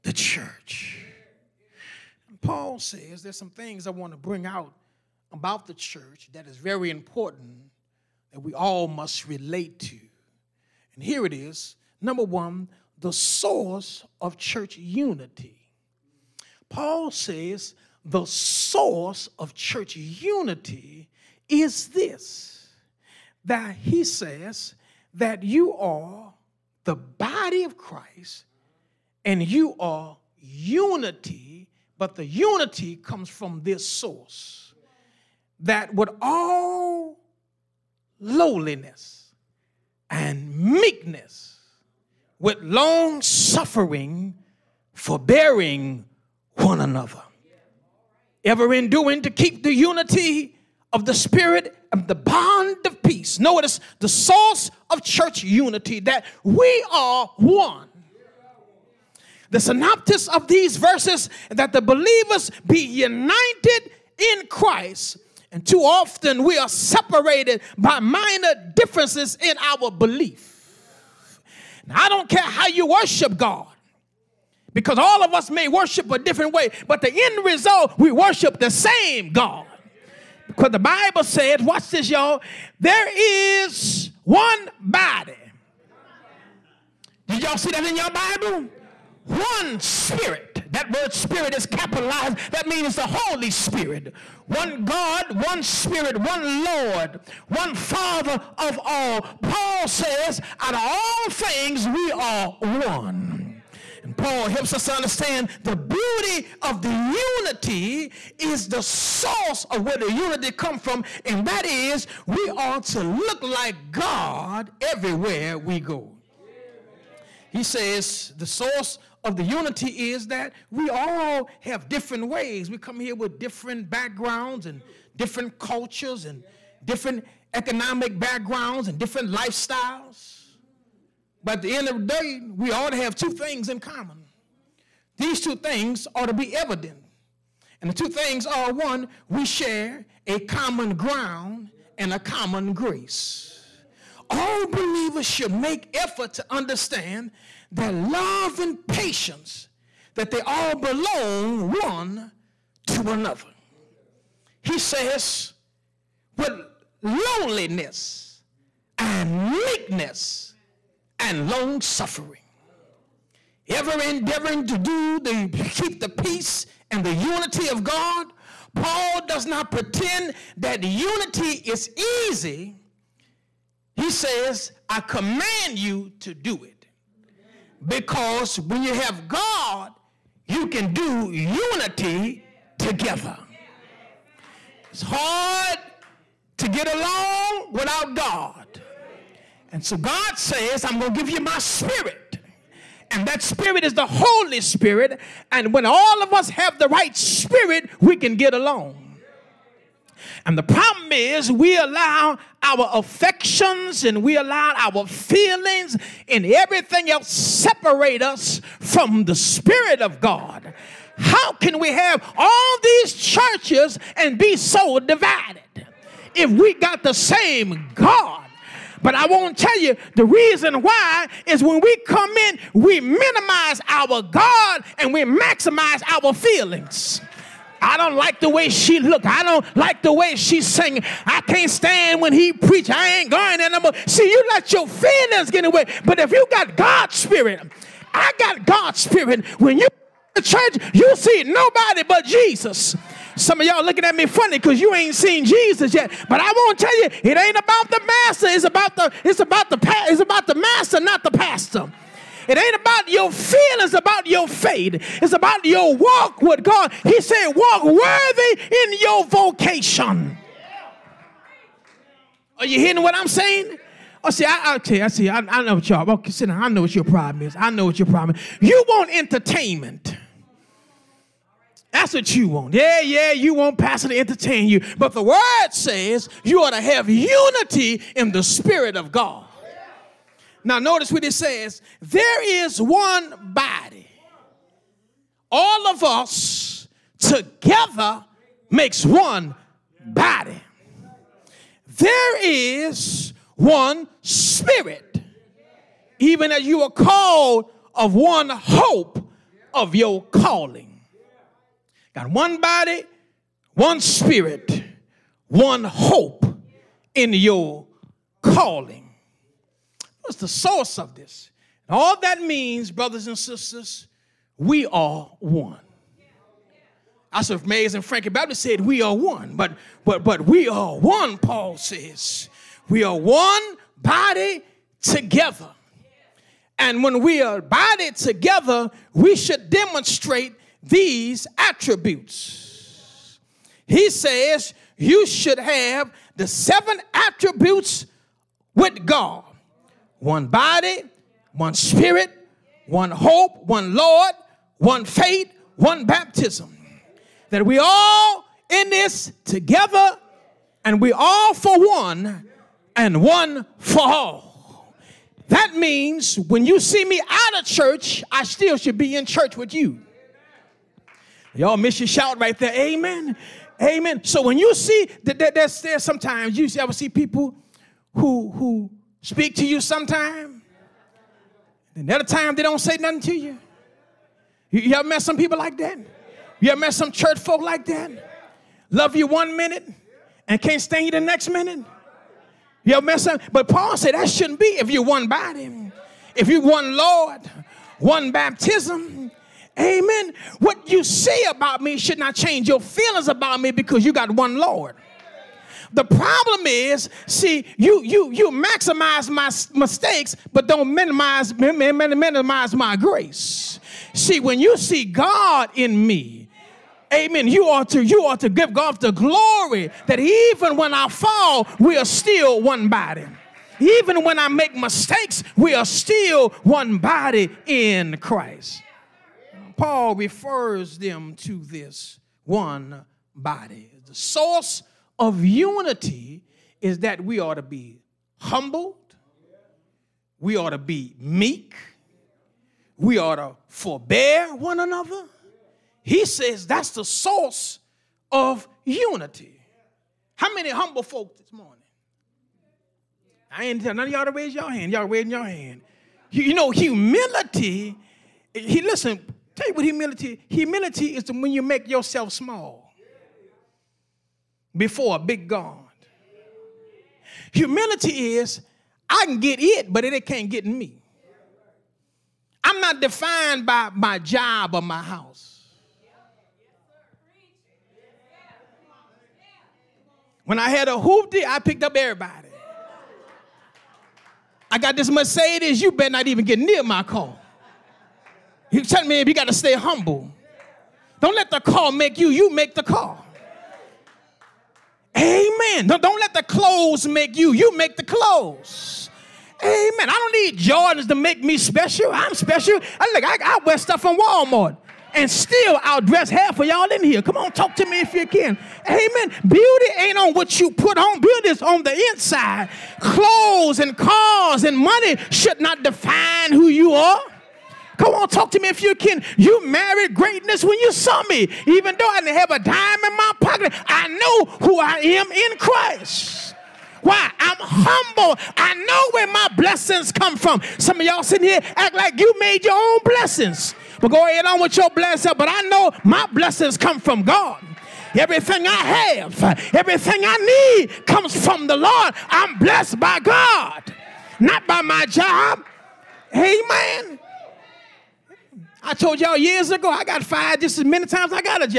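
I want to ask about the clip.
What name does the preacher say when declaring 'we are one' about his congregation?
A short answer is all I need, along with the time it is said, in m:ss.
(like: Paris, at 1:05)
Mays and Frankie Baptist, at 5:17.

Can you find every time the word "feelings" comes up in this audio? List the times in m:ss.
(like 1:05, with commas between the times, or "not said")
3:25, 3:46, 3:54, 4:13, 6:32.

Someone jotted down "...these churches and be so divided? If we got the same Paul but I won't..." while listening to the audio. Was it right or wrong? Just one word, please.
wrong.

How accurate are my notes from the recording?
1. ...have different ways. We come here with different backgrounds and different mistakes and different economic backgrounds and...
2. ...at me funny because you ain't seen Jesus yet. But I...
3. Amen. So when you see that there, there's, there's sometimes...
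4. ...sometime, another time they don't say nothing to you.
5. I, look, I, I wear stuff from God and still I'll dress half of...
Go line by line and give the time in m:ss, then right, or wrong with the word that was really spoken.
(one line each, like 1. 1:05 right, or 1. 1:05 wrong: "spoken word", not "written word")
1. 2:01 wrong: "cultures", not "mistakes"
2. 4:04 right
3. 6:03 right
4. 6:09 right
5. 8:12 wrong: "Walmart", not "God".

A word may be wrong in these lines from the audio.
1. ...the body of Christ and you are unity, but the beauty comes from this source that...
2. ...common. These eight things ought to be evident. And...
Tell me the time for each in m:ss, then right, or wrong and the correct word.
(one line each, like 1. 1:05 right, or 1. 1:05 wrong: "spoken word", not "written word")
1. 0:26 wrong: "unity", not "beauty"
2. 2:13 wrong: "two", not "eight".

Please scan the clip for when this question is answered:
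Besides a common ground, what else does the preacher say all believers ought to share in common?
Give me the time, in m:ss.
2:22.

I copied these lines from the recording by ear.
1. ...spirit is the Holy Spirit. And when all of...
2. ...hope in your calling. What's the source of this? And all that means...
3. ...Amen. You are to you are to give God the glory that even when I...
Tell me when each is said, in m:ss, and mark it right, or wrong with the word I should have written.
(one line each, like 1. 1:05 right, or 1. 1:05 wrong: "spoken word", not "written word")
1. 3:13 right
2. 5:05 right
3. 6:47 right.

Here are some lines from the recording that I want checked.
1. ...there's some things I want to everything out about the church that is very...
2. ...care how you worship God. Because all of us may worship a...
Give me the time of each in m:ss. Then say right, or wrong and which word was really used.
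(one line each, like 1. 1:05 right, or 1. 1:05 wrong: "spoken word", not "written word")
1. 0:03 wrong: "bring", not "everything"
2. 1:12 right.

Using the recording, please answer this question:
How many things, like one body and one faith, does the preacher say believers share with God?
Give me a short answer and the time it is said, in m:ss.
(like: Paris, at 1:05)
7, at 5:36.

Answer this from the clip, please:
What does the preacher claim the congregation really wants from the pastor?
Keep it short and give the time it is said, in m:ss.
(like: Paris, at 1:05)
entertainment, at 4:28.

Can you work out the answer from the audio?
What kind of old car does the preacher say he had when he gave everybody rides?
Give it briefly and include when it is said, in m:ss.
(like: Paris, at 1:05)
a hoopty, at 7:50.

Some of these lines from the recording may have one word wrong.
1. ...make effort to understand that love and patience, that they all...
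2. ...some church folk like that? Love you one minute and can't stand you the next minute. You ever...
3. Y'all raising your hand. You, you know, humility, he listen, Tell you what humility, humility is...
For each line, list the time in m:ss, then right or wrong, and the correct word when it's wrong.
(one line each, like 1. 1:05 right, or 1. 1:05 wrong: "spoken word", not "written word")
1. 2:25 right
2. 6:16 right
3. 7:24 right.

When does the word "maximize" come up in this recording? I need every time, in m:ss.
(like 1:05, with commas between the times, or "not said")
3:45, 6:38.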